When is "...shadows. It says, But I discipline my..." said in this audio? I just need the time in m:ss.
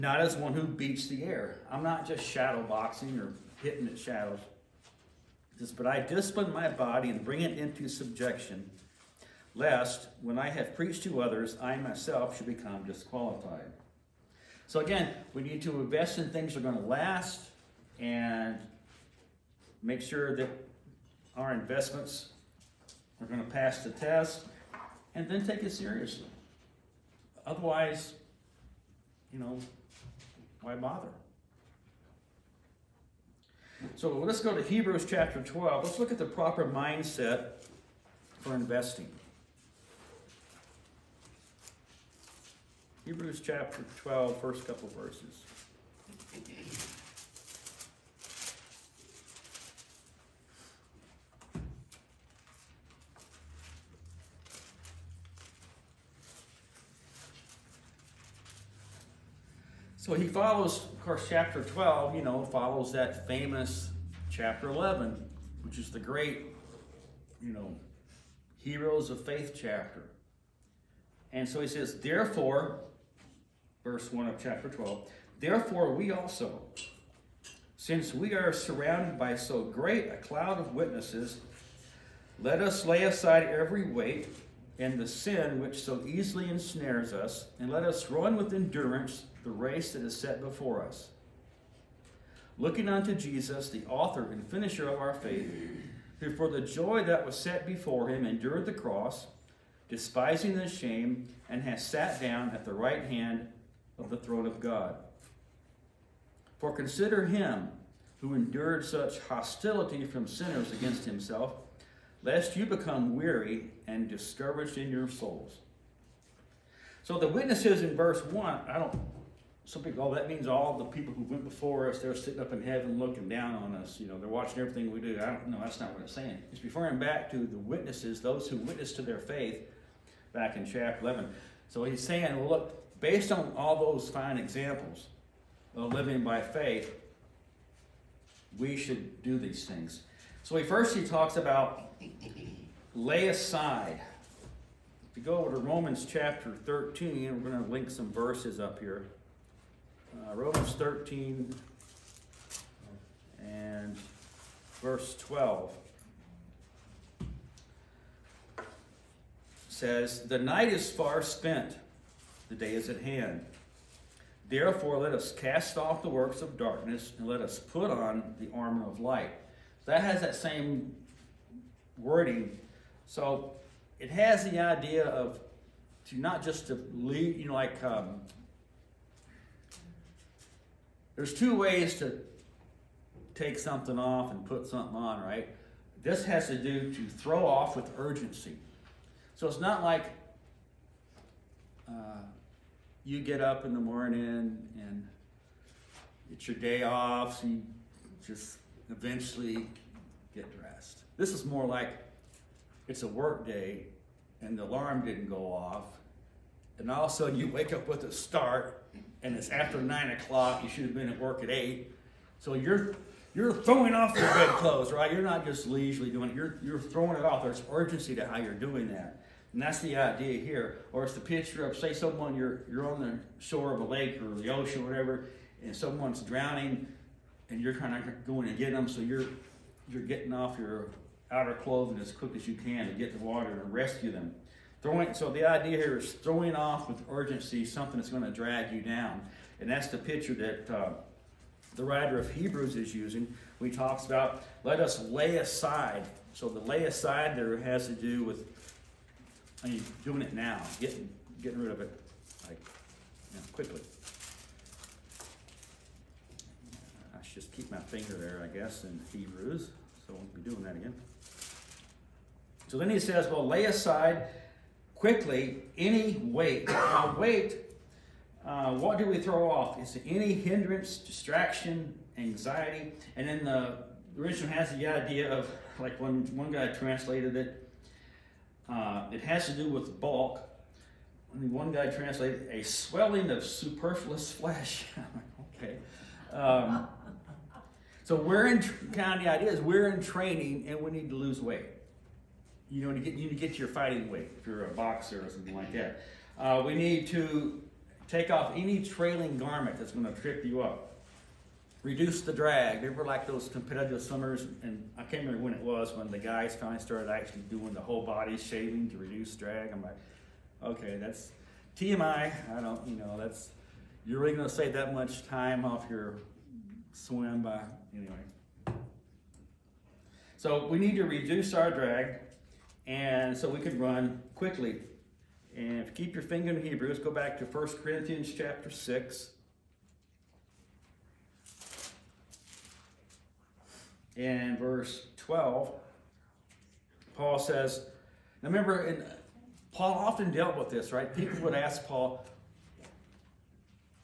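0:03.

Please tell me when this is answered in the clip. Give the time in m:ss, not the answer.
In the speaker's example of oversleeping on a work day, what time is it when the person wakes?
3:29.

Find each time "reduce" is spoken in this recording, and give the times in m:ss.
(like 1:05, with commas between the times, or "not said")
5:01, 5:08, 5:21.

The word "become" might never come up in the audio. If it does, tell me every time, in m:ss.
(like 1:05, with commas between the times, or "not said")
0:12, 1:52.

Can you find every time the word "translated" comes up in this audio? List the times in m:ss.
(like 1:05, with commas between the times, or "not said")
4:36, 4:41.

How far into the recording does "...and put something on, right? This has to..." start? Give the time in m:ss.
3:04.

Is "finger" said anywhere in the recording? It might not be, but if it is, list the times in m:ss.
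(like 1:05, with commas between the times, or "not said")
4:17, 5:26.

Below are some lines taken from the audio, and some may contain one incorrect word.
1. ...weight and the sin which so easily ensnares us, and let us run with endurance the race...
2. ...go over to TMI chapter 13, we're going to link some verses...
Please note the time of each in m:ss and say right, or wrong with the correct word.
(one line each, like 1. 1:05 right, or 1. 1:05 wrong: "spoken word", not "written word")
1. 1:23 right
2. 2:25 wrong: "Romans", not "TMI".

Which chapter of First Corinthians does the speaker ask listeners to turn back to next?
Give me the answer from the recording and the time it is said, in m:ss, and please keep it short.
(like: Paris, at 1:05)
Chapter 6, at 5:27.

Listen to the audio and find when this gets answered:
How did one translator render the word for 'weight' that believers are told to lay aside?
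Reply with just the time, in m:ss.
4:42.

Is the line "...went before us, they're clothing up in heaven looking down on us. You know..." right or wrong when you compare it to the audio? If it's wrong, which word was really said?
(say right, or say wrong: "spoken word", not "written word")
wrong: "sitting", not "clothing".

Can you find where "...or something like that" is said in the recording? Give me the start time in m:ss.
4:55.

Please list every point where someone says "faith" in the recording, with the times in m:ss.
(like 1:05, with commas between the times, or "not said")
1:09, 1:35, 2:09, 2:16.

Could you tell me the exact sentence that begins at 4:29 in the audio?
Is it any hindrance, distraction, anxiety.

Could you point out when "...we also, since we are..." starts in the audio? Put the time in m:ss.
1:15.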